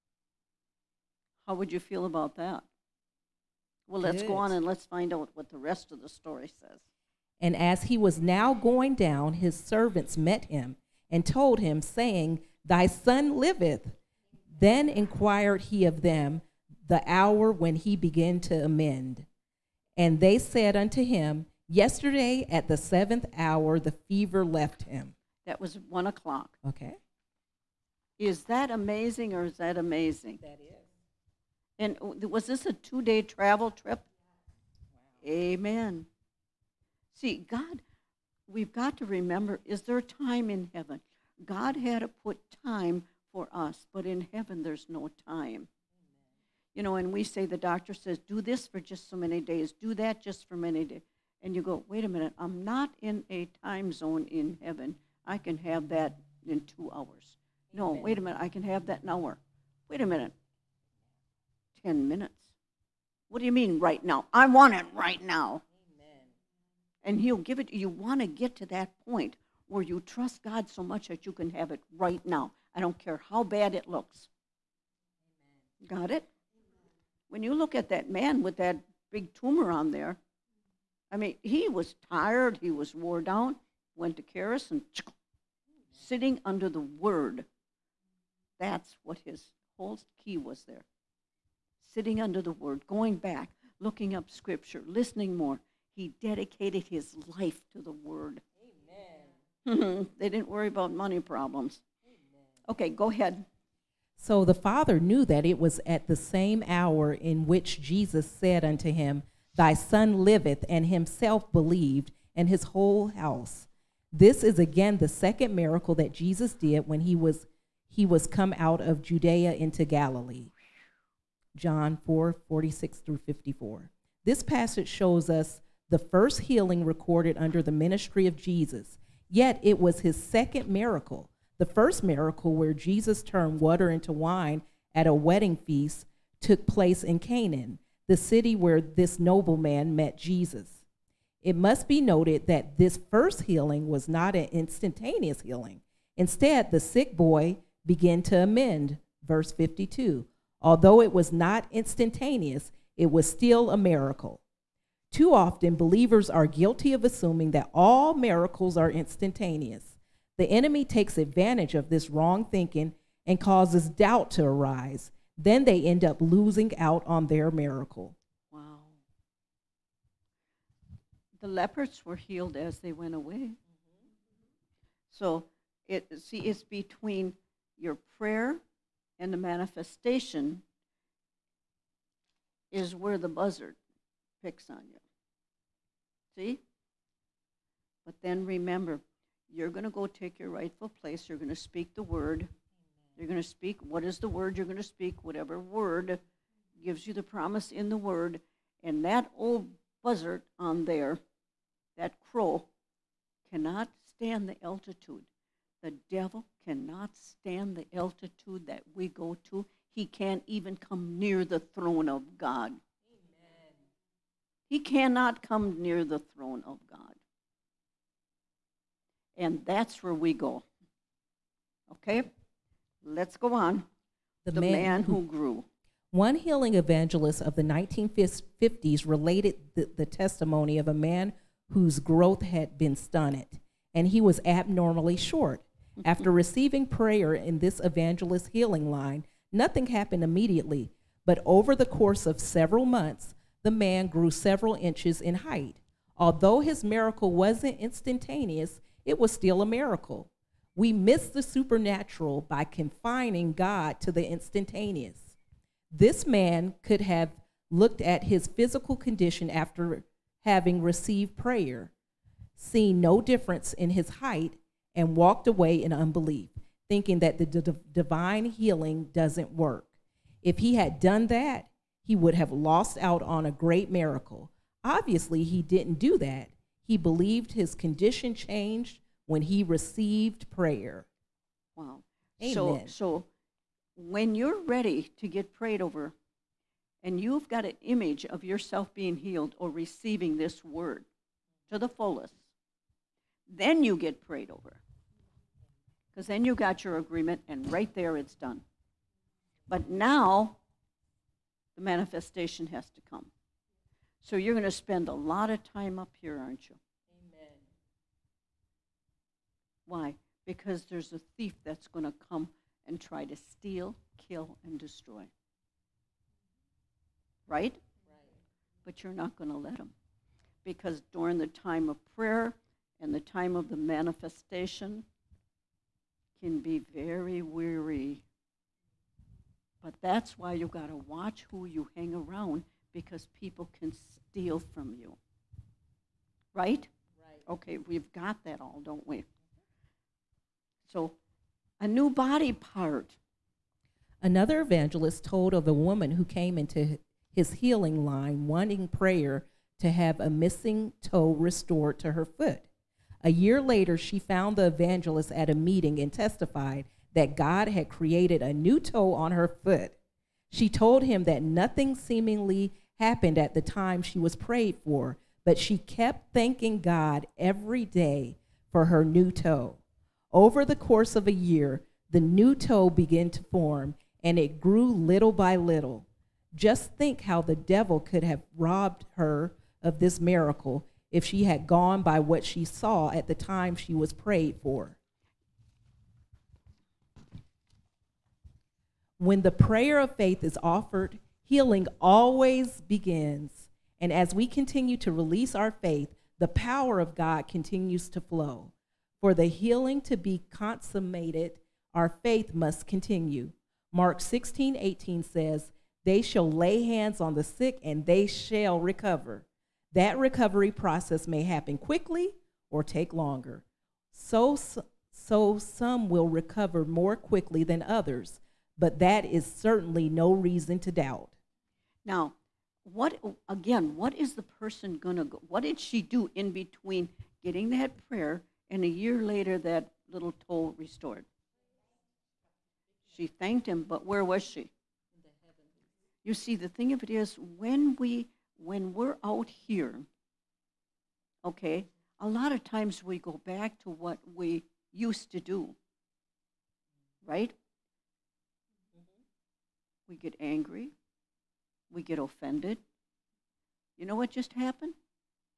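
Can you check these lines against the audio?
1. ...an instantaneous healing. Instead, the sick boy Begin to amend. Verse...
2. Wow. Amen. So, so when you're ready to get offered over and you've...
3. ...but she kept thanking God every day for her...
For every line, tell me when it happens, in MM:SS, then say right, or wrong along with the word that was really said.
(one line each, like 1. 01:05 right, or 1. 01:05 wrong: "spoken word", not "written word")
1. 02:24 right
2. 04:41 wrong: "prayed", not "offered"
3. 06:05 right.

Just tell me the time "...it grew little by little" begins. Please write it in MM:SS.
06:14.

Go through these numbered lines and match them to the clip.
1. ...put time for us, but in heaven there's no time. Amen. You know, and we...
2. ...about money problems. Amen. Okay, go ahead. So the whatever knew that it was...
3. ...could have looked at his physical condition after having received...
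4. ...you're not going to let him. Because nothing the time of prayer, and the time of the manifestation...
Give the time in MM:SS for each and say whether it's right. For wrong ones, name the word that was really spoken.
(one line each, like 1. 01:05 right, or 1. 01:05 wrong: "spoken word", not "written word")
1. 00:42 right
2. 01:40 wrong: "father", not "whatever"
3. 04:16 right
4. 05:19 wrong: "during", not "nothing".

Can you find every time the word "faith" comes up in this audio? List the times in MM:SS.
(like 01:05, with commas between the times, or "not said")
06:30, 06:35, 06:42.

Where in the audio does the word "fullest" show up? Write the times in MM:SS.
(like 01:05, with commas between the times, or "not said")
04:51.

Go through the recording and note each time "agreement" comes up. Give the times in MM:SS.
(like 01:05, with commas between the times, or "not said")
04:56.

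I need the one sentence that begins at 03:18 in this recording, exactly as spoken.
And that old buzzard on there, that crow, cannot stand the altitude.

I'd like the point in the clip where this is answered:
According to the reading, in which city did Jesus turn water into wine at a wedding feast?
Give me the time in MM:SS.
02:17.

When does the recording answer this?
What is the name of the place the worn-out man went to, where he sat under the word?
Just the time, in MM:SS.
01:24.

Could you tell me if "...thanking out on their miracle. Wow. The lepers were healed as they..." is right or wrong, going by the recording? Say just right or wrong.
wrong.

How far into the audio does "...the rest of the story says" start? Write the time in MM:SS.
00:05.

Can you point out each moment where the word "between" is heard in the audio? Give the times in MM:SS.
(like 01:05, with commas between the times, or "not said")
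02:56, 07:06.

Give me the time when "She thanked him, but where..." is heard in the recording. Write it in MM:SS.
07:13.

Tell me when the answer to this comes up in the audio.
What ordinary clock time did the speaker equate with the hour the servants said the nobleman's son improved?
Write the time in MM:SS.
00:25.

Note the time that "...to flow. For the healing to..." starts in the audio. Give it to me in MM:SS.
06:38.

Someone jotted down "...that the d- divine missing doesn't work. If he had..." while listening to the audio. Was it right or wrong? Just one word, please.
wrong.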